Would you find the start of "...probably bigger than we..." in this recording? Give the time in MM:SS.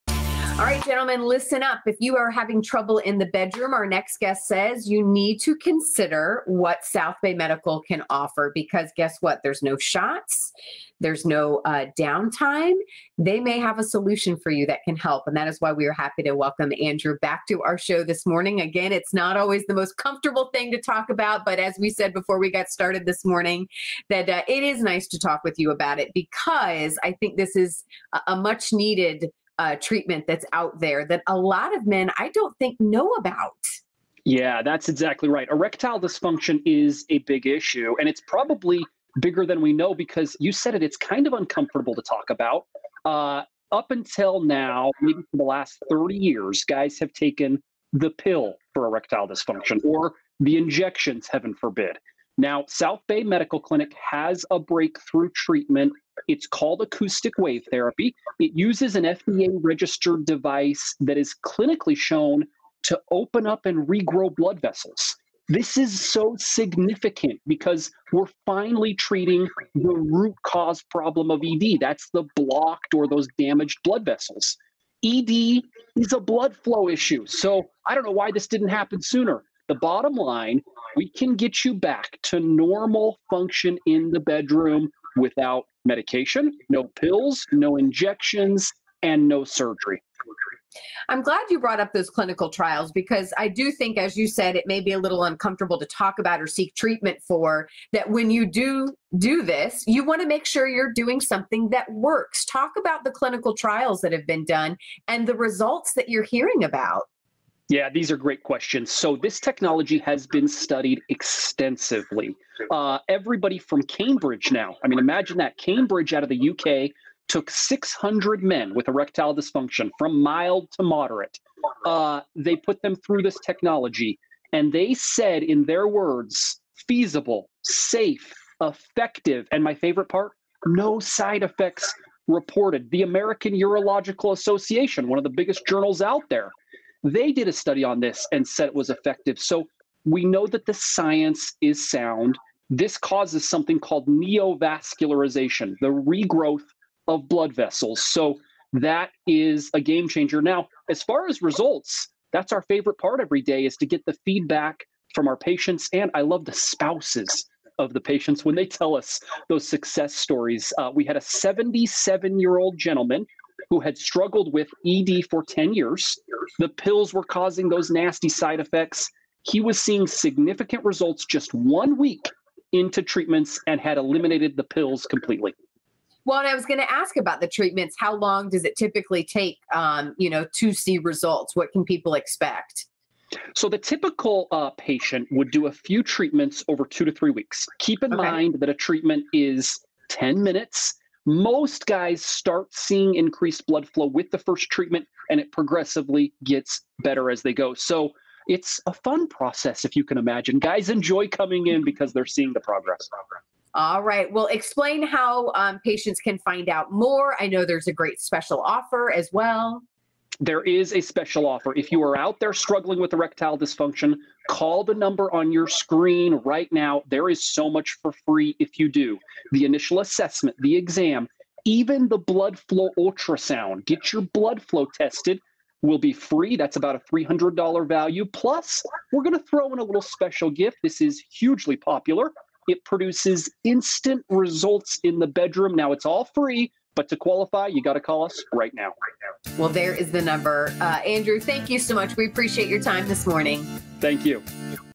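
00:38.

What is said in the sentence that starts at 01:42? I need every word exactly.
Talk about the clinical trials that have been done and the results that you're hearing about.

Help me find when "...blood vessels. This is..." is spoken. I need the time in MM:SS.
01:04.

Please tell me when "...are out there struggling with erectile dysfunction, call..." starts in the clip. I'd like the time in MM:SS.
03:32.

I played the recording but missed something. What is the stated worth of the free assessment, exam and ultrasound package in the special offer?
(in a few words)
$300.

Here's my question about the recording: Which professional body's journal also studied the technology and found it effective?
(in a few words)
American Urological Association.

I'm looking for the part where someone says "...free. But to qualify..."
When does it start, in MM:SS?
03:56.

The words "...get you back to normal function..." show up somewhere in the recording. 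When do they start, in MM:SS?
01:21.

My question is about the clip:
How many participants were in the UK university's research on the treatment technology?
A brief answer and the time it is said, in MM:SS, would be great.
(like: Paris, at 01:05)
600, at 01:57.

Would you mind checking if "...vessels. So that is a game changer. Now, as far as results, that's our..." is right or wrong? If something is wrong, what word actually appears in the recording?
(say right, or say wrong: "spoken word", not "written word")
right.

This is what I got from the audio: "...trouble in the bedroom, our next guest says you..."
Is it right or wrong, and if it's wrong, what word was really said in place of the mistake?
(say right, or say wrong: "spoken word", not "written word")
right.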